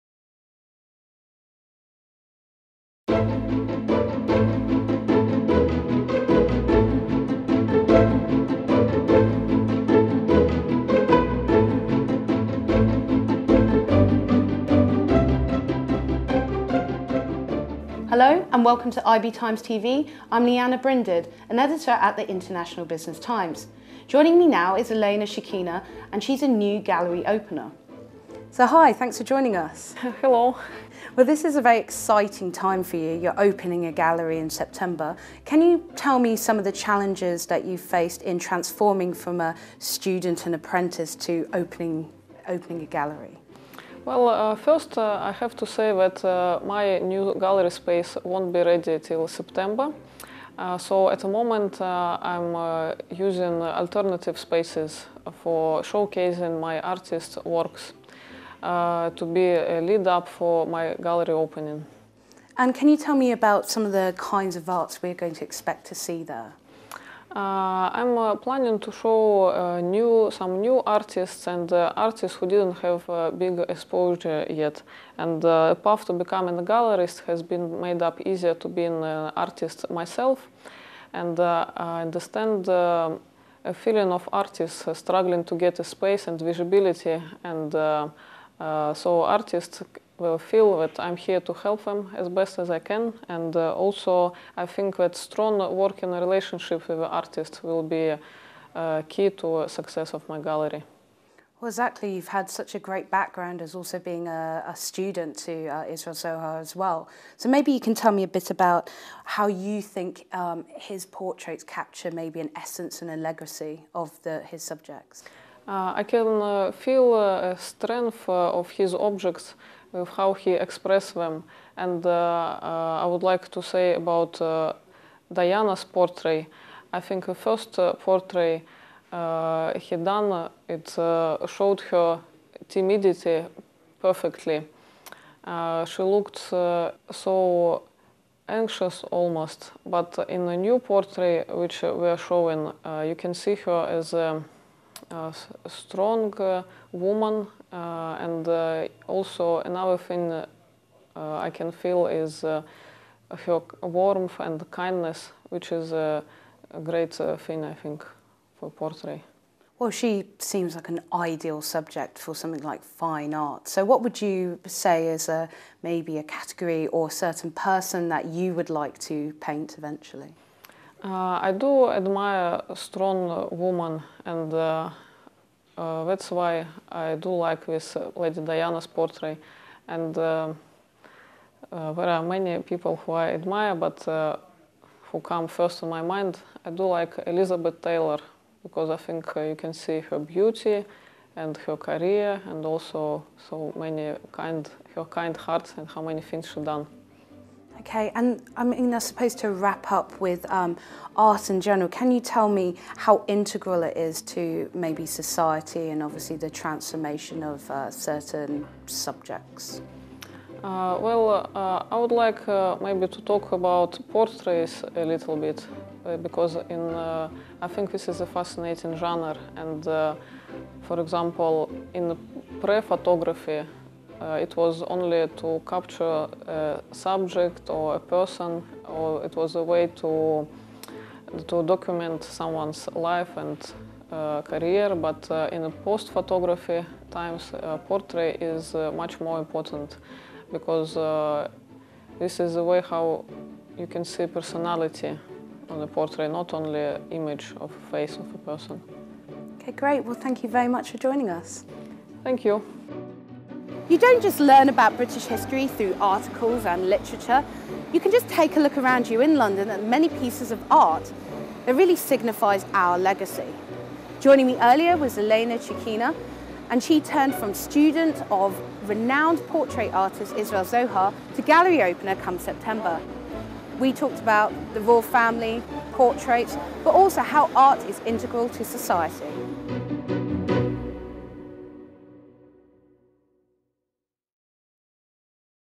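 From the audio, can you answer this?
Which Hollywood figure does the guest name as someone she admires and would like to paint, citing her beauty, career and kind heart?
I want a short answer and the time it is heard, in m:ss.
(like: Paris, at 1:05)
Elizabeth Taylor, at 3:07.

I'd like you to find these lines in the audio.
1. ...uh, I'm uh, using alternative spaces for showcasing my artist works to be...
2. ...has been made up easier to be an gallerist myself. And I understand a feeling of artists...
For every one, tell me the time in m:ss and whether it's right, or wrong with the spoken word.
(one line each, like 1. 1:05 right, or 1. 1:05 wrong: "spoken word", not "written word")
1. 0:51 right
2. 1:17 wrong: "artist", not "gallerist".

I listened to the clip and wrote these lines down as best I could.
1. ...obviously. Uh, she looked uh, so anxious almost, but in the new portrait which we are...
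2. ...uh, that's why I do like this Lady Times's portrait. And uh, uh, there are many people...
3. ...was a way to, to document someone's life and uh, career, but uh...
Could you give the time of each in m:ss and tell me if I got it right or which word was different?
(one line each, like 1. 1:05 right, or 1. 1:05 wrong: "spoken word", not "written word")
1. 2:14 wrong: "perfectly", not "obviously"
2. 2:55 wrong: "Diana", not "Times"
3. 3:49 right.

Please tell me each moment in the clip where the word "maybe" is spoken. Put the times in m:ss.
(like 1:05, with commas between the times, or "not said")
1:47, 1:52, 2:45, 3:24, 3:32.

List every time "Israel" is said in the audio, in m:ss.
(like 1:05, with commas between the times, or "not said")
1:45, 4:30.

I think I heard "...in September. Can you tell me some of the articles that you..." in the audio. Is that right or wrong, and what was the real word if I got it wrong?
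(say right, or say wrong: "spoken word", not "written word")
wrong: "challenges", not "articles".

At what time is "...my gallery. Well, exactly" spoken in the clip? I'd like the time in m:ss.
1:40.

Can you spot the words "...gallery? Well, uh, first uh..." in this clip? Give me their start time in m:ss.
0:42.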